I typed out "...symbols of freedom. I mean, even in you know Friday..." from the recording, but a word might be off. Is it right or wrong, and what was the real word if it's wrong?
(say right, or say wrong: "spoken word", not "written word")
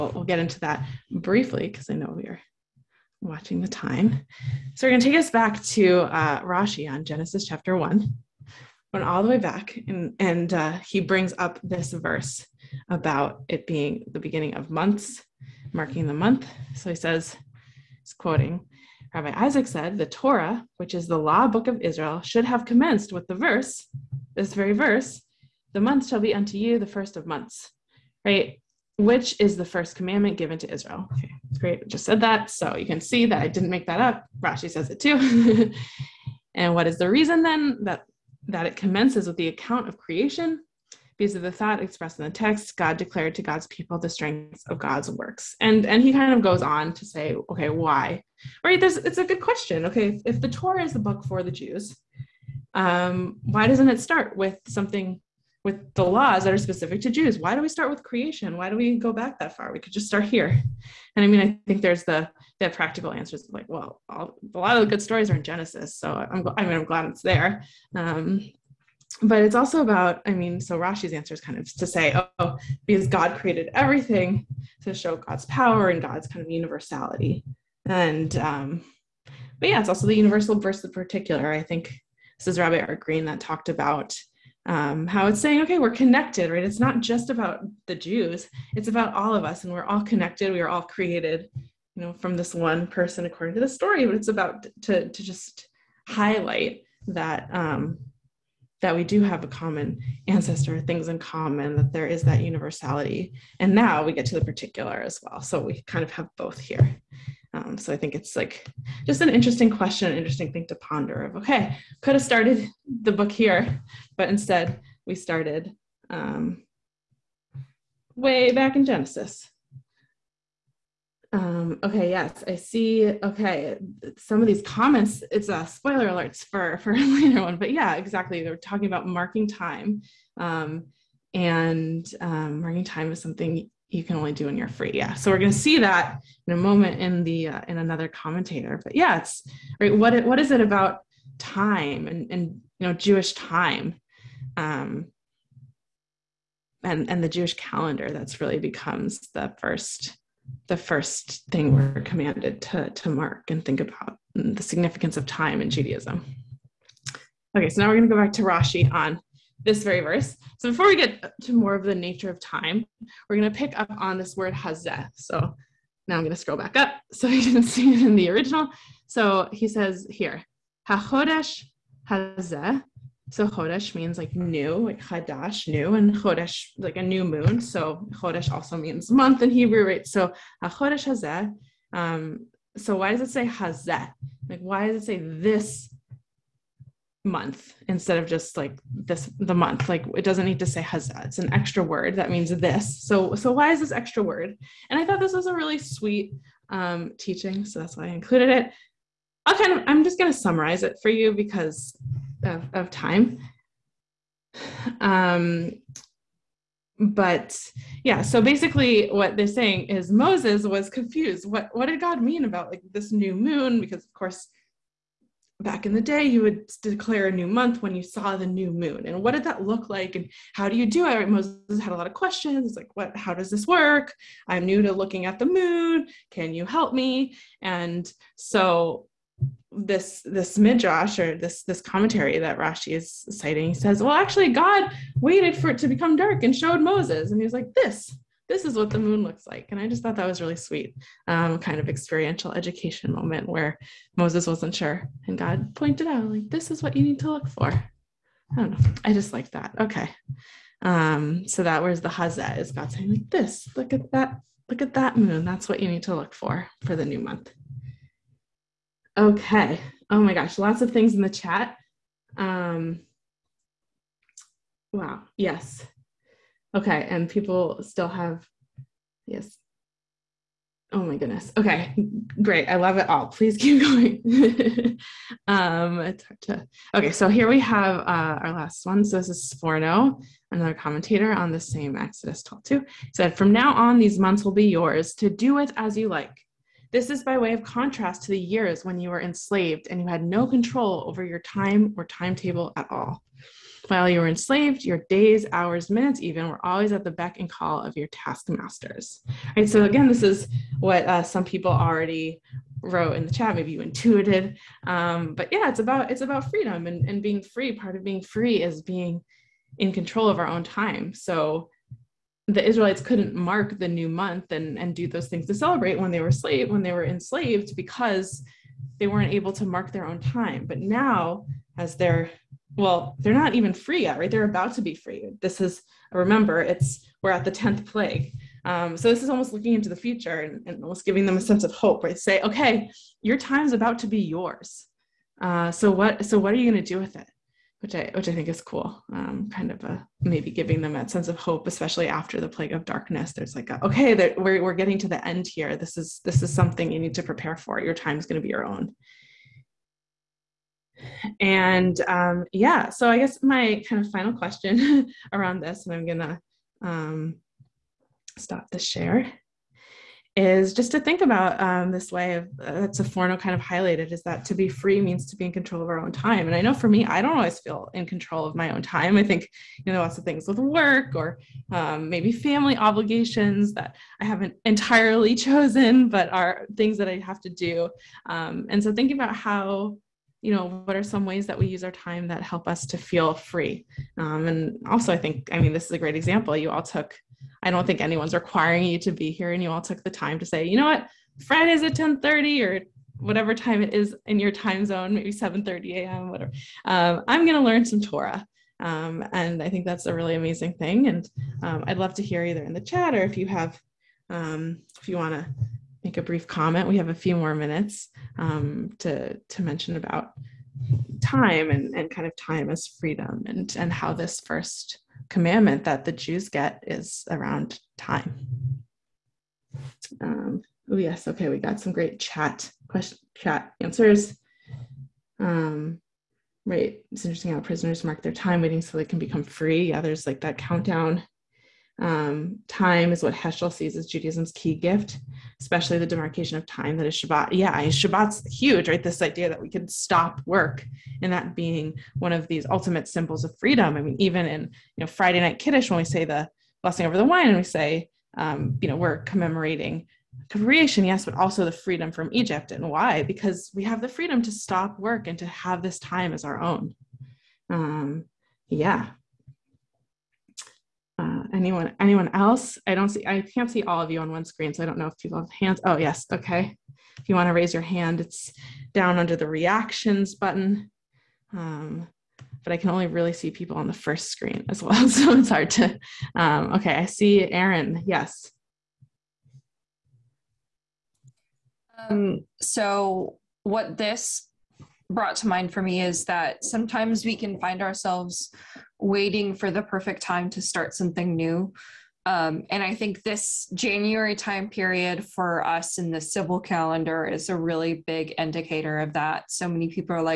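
right.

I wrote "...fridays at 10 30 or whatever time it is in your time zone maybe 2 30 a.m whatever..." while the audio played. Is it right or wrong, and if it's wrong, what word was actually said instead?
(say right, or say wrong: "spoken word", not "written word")
wrong: "7", not "2".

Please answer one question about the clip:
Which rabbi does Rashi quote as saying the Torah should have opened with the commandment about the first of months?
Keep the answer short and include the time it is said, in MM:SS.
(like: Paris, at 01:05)
Rabbi Isaac, at 00:19.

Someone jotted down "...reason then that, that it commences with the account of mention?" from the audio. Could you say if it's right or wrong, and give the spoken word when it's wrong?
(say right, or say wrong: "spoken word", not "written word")
wrong: "creation", not "mention".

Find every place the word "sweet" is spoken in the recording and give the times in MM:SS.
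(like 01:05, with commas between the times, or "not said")
03:15, 04:00.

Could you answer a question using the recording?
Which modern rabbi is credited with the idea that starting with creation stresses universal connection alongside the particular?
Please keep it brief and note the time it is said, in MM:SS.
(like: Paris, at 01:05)
Art Green, at 01:22.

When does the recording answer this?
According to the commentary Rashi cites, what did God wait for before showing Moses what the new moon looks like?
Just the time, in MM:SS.
03:56.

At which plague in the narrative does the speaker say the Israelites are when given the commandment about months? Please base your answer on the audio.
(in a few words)
The 10th plague.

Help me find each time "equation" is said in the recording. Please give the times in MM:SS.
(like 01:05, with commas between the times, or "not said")
not said.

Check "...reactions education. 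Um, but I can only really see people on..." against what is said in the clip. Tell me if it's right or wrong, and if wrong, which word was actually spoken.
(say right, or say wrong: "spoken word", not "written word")
wrong: "button", not "education".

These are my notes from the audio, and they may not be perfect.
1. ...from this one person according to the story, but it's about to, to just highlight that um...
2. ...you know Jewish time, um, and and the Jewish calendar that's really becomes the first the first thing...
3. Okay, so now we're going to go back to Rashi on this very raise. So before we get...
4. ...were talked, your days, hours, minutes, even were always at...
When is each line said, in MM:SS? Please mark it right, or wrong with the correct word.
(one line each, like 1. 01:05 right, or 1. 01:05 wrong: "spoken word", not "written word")
1. 01:32 right
2. 02:22 right
3. 02:37 wrong: "verse", not "raise"
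4. 04:54 wrong: "enslaved", not "talked".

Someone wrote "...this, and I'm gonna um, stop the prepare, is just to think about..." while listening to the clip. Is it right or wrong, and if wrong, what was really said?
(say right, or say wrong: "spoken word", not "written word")
wrong: "share", not "prepare".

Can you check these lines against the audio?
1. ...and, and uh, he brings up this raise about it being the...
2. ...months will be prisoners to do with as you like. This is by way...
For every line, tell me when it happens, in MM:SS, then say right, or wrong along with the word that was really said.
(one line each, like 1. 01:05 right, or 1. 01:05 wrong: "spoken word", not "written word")
1. 00:09 wrong: "verse", not "raise"
2. 04:44 wrong: "yours", not "prisoners".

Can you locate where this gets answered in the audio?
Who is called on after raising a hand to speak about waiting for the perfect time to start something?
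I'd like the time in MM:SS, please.
07:57.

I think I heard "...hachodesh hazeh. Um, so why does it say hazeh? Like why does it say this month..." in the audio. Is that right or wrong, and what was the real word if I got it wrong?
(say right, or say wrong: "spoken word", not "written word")
right.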